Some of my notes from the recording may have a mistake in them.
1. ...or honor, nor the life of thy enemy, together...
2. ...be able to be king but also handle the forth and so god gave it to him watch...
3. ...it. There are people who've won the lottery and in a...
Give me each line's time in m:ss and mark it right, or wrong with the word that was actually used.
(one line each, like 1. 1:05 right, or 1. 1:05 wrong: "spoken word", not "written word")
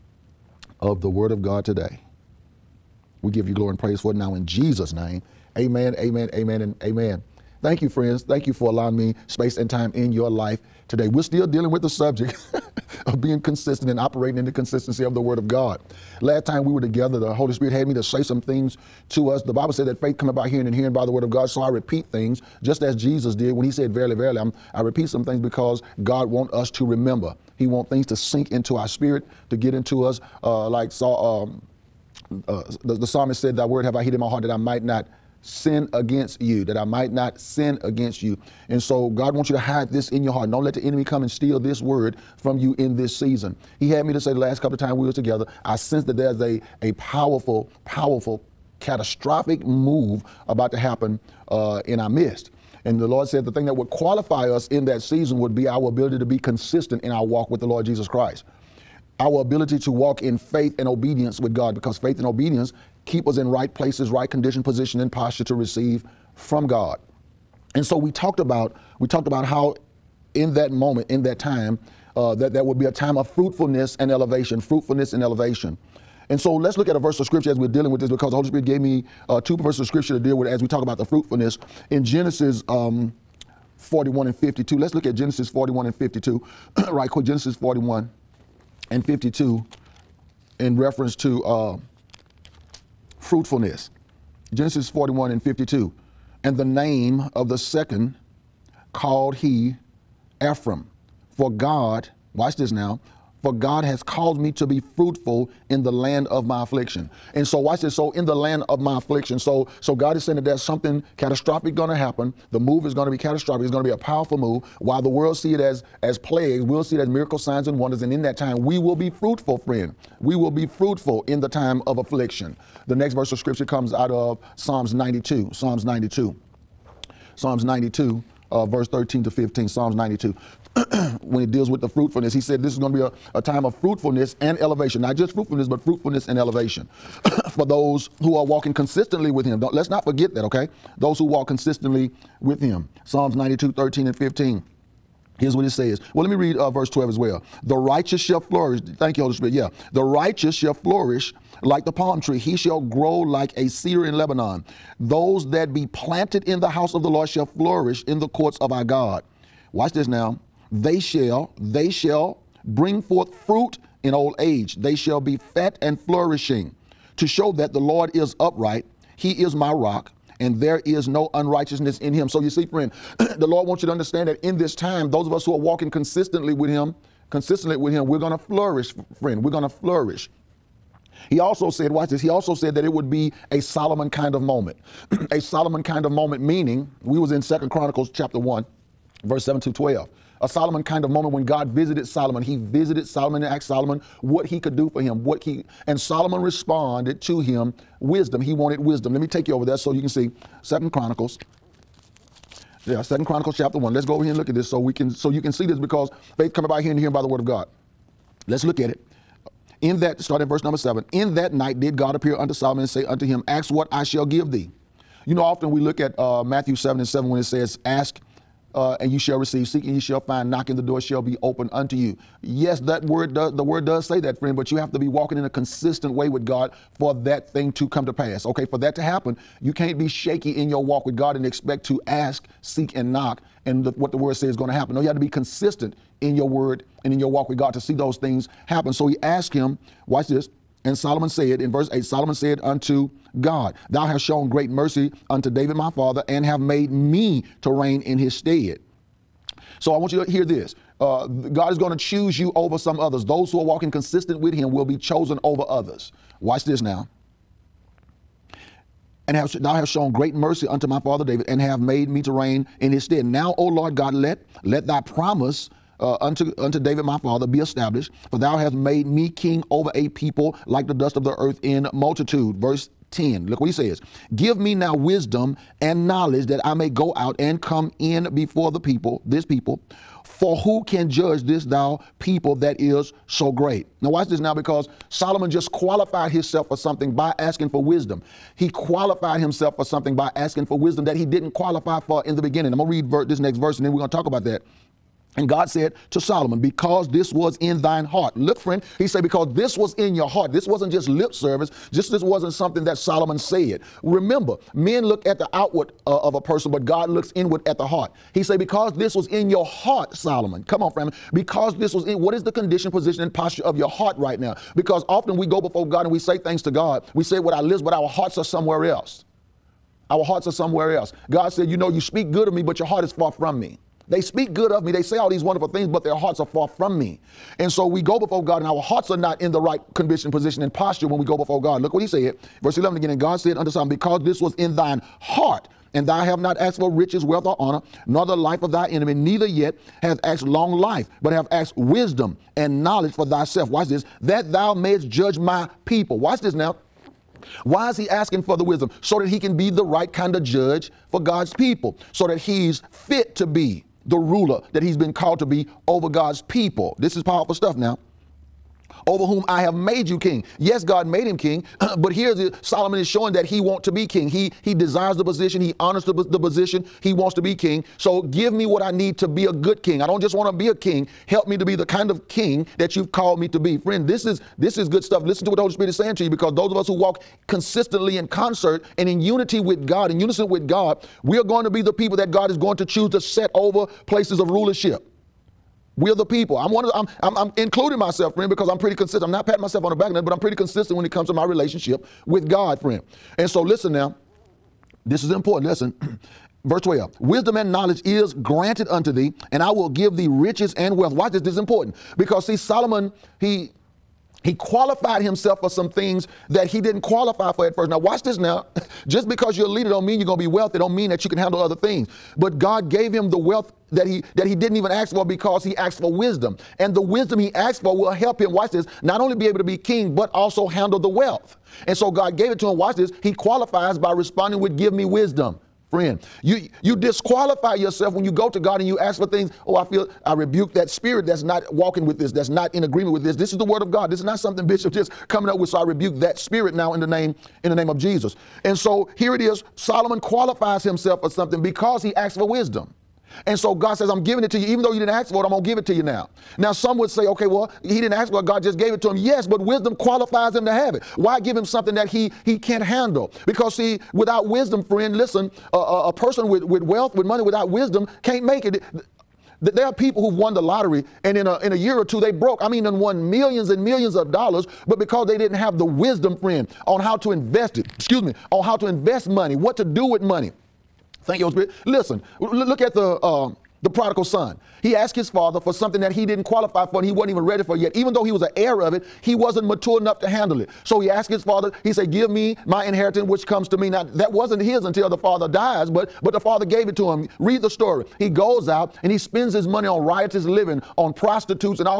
1. 5:37 wrong: "neither", not "together"
2. 6:59 wrong: "wealth", not "forth"
3. 7:38 right.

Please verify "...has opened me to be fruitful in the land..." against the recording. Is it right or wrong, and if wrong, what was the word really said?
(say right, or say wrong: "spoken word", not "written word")
wrong: "caused", not "opened".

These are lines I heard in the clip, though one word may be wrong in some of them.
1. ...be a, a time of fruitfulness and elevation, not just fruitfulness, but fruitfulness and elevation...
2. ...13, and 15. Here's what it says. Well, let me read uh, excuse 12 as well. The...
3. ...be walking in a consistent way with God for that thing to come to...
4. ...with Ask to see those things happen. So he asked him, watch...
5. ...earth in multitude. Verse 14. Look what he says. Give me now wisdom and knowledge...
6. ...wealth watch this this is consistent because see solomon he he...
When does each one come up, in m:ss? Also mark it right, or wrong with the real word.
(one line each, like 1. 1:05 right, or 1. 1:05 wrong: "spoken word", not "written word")
1. 2:12 right
2. 2:23 wrong: "verse", not "excuse"
3. 3:44 right
4. 3:57 wrong: "God", not "Ask"
5. 4:31 wrong: "10", not "14"
6. 6:40 wrong: "important", not "consistent".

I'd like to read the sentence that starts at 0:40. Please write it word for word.
Don't let the enemy come and steal this word from you in this season.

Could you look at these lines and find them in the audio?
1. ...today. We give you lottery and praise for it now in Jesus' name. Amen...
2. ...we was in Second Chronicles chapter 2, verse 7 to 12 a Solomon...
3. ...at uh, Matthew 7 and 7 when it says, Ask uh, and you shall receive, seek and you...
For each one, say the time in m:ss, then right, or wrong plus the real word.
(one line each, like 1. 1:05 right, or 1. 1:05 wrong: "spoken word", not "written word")
1. 0:01 wrong: "glory", not "lottery"
2. 3:07 wrong: "1", not "2"
3. 3:35 right.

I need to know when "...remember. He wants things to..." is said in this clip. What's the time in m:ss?
0:26.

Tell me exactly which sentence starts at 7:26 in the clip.
Now, some would say, okay, well, he didn't ask for it.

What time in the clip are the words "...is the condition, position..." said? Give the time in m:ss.
5:12.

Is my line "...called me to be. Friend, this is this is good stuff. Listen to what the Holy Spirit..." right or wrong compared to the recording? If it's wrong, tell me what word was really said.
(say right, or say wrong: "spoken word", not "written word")
right.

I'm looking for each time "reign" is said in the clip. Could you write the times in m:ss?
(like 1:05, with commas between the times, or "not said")
4:07, 4:22.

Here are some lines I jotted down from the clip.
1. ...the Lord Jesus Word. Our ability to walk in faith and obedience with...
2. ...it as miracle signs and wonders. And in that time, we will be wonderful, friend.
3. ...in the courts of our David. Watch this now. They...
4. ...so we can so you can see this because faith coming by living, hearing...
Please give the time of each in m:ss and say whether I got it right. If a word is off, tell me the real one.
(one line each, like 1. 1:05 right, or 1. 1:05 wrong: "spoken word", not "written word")
1. 0:57 wrong: "Christ", not "Word"
2. 1:56 wrong: "fruitful", not "wonderful"
3. 2:38 wrong: "God", not "David"
4. 3:24 wrong: "hearing", not "living".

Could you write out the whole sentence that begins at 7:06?
You you disqualify yourself when you go to God and you ask for things.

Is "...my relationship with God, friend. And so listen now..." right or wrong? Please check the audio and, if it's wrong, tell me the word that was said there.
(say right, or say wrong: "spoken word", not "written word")
right.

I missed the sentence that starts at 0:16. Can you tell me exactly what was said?
Last time we were together, the Holy Spirit had me to say some things to us.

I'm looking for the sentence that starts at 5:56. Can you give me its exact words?
This is powerful stuff now over whom I have made you king.